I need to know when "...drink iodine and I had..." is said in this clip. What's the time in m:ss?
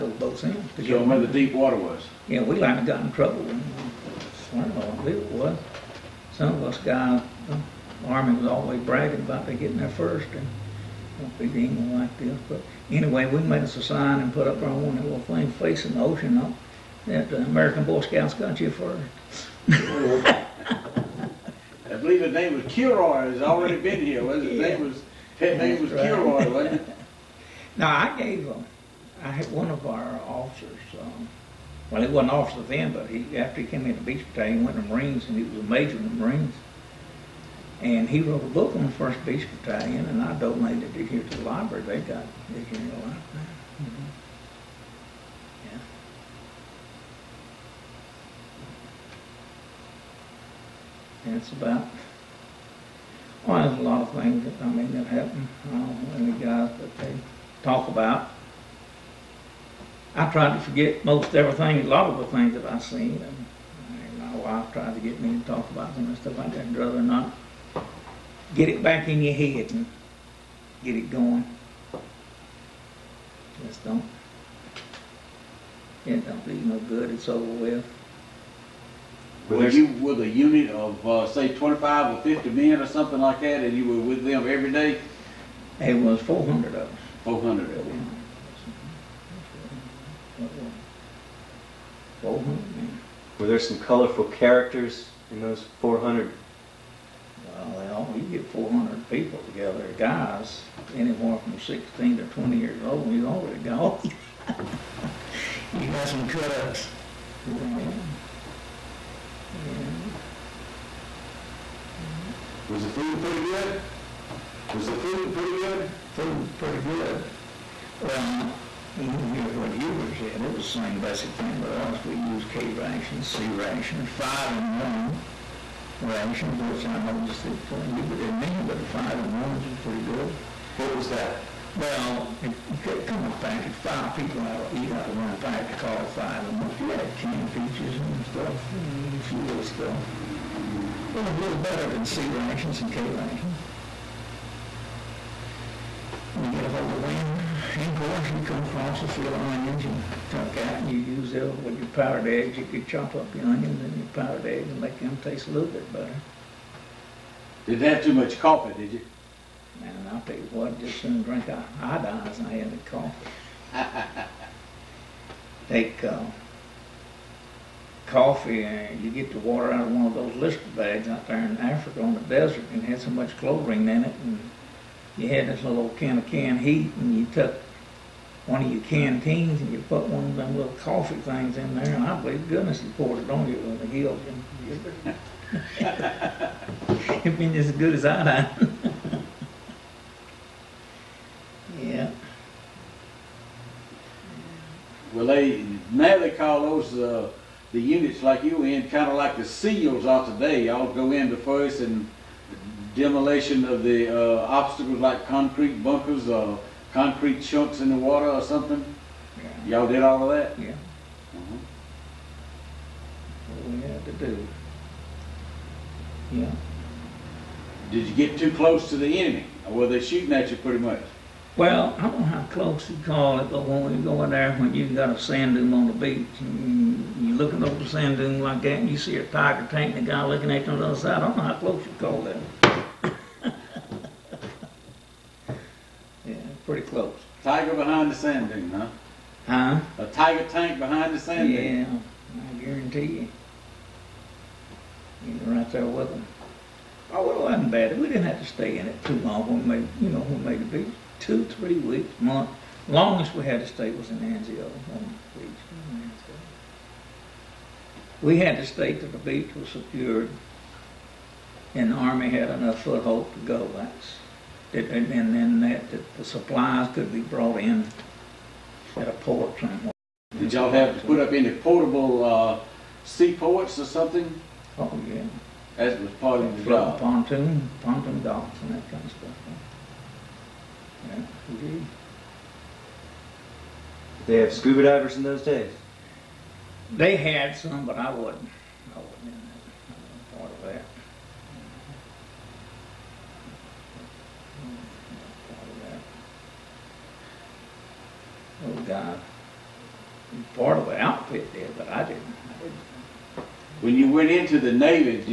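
2:41.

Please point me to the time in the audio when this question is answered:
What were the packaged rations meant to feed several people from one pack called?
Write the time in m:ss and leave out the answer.
2:04.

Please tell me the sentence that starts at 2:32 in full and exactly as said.
You could chop up the onions and your powdered eggs and make them taste a little bit better.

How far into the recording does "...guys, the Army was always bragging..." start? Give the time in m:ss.
0:06.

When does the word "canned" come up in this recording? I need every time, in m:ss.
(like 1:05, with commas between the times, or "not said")
2:17, 2:56.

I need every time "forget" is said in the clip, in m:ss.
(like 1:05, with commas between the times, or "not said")
1:00.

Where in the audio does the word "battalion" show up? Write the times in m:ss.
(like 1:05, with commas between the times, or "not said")
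0:34, 0:39.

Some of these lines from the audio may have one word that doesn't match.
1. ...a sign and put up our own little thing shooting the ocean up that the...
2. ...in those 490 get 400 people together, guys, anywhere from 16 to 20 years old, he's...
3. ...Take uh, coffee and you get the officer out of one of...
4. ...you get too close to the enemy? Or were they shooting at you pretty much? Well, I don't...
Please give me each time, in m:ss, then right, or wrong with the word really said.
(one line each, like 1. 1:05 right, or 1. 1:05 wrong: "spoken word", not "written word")
1. 0:13 wrong: "facing", not "shooting"
2. 1:35 wrong: "400", not "490"
3. 2:45 wrong: "water", not "officer"
4. 3:38 right.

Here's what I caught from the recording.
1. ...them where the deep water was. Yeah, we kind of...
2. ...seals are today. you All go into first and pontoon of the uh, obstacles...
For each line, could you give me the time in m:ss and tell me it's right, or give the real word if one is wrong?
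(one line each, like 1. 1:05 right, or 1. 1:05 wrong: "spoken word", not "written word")
1. 0:00 right
2. 3:19 wrong: "demolition", not "pontoon".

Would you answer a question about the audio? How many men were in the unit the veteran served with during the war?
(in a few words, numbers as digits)
400.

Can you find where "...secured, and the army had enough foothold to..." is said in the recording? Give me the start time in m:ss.
4:19.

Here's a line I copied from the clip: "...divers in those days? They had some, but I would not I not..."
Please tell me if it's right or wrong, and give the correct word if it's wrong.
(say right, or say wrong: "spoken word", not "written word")
right.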